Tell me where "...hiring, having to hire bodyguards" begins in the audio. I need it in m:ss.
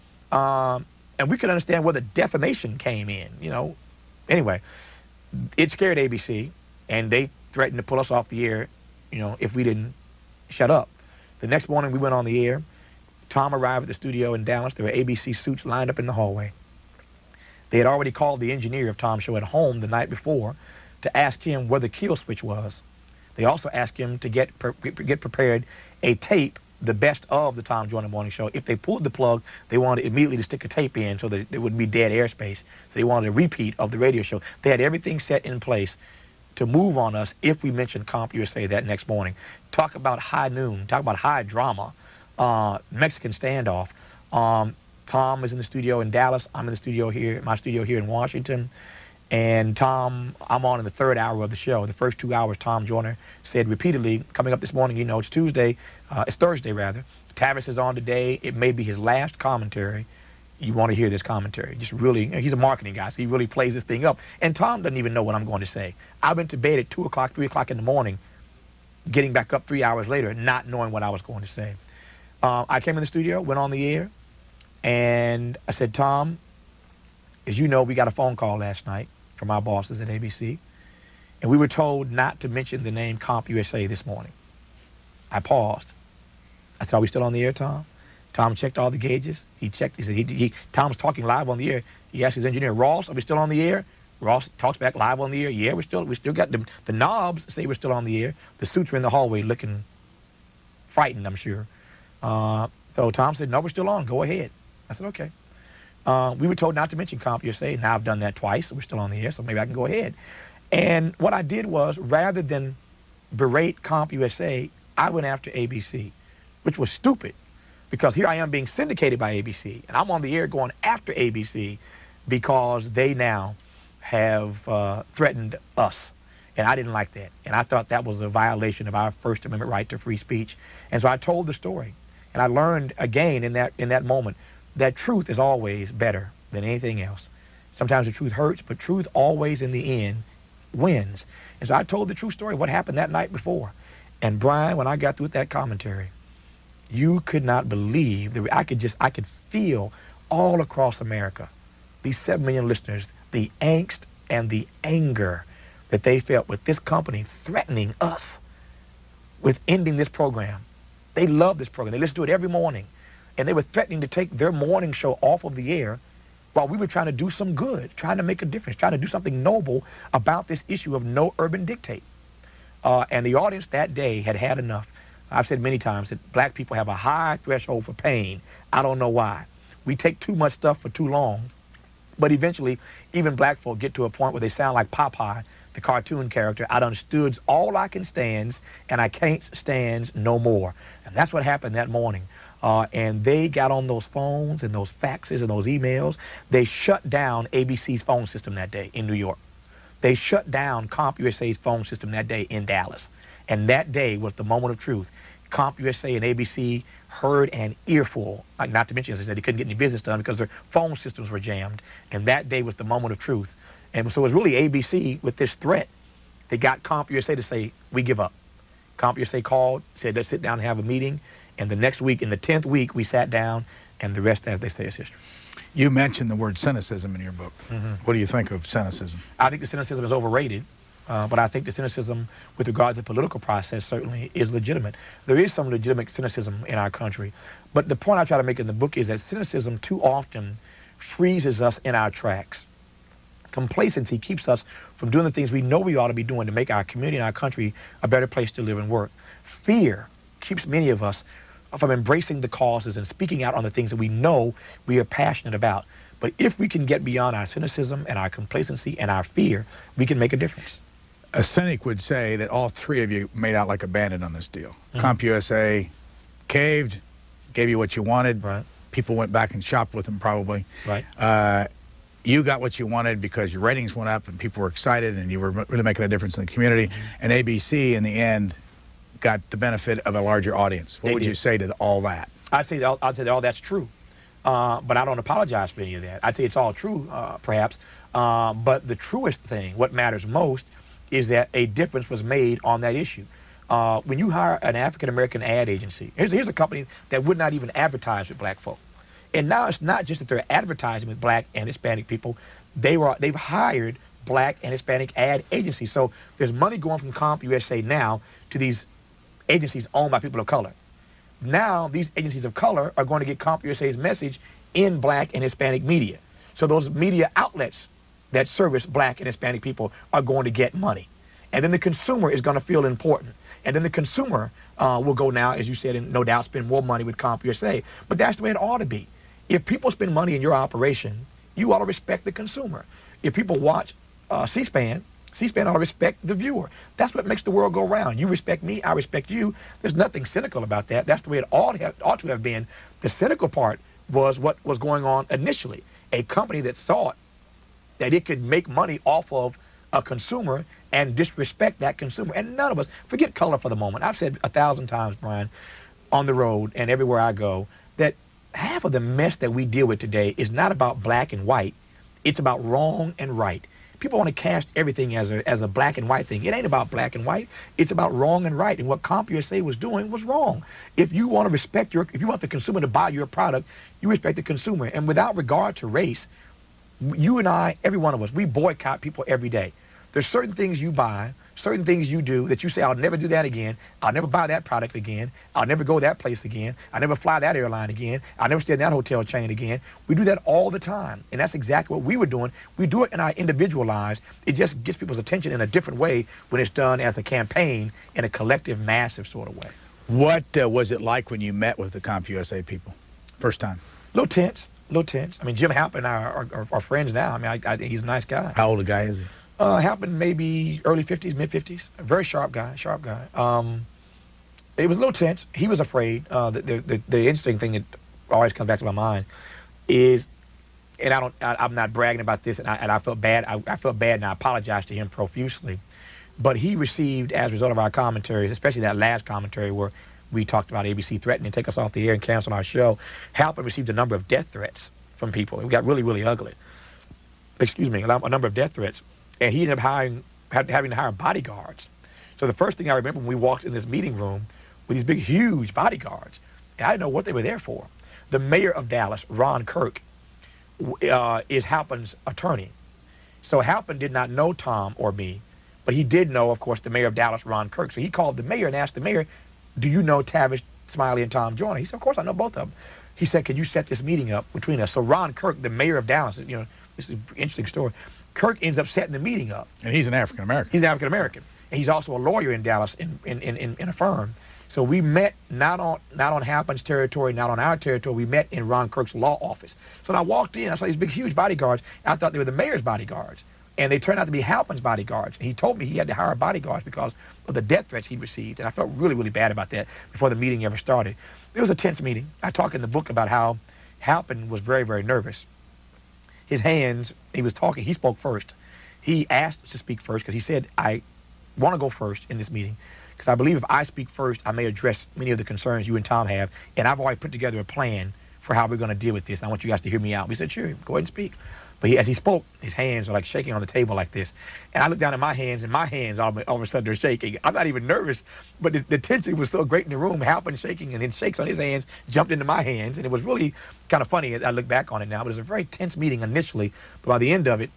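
7:19.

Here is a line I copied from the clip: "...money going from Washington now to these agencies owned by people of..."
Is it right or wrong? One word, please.
wrong.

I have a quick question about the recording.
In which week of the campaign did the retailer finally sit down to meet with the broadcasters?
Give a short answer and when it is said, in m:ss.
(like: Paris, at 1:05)
10th week, at 3:42.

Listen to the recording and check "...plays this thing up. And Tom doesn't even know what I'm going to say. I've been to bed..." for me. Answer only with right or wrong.
right.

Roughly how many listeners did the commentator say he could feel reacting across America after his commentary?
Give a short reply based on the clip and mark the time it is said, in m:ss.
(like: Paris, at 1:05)
7 million, at 2:32.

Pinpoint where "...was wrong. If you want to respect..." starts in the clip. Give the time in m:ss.
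6:10.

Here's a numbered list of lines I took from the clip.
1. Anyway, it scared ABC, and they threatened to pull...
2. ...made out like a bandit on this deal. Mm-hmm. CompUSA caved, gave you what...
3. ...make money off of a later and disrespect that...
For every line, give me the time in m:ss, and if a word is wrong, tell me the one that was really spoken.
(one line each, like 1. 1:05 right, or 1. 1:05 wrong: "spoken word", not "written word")
1. 0:04 right
2. 4:23 right
3. 5:48 wrong: "consumer", not "later".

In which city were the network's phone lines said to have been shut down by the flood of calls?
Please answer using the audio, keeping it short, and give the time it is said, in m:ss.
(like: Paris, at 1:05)
New York, at 3:19.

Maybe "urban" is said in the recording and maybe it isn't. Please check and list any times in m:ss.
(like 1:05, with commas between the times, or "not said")
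2:51.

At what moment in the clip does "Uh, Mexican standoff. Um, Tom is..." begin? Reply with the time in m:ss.
0:42.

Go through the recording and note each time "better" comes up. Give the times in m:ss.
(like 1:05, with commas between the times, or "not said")
2:15, 4:08.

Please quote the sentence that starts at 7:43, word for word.
He said, can you set this meeting up between us?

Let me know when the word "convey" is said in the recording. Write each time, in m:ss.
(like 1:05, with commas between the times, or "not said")
not said.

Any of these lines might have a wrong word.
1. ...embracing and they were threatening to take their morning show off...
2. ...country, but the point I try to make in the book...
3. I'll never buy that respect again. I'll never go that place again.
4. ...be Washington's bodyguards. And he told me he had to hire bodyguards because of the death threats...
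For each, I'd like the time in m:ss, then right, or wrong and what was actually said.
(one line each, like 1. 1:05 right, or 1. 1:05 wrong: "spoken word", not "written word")
1. 2:42 wrong: "morning", not "embracing"
2. 3:56 right
3. 6:24 wrong: "product", not "respect"
4. 8:04 wrong: "Halpin", not "Washington".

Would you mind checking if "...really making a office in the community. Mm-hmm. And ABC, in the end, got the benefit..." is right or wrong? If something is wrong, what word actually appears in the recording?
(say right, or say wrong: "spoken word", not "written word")
wrong: "difference", not "office".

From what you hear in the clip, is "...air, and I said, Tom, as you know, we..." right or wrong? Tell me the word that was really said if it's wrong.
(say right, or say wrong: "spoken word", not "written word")
right.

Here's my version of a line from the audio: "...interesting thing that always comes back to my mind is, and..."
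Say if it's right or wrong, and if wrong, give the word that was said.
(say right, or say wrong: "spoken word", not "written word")
right.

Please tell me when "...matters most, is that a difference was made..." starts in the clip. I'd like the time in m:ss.
4:49.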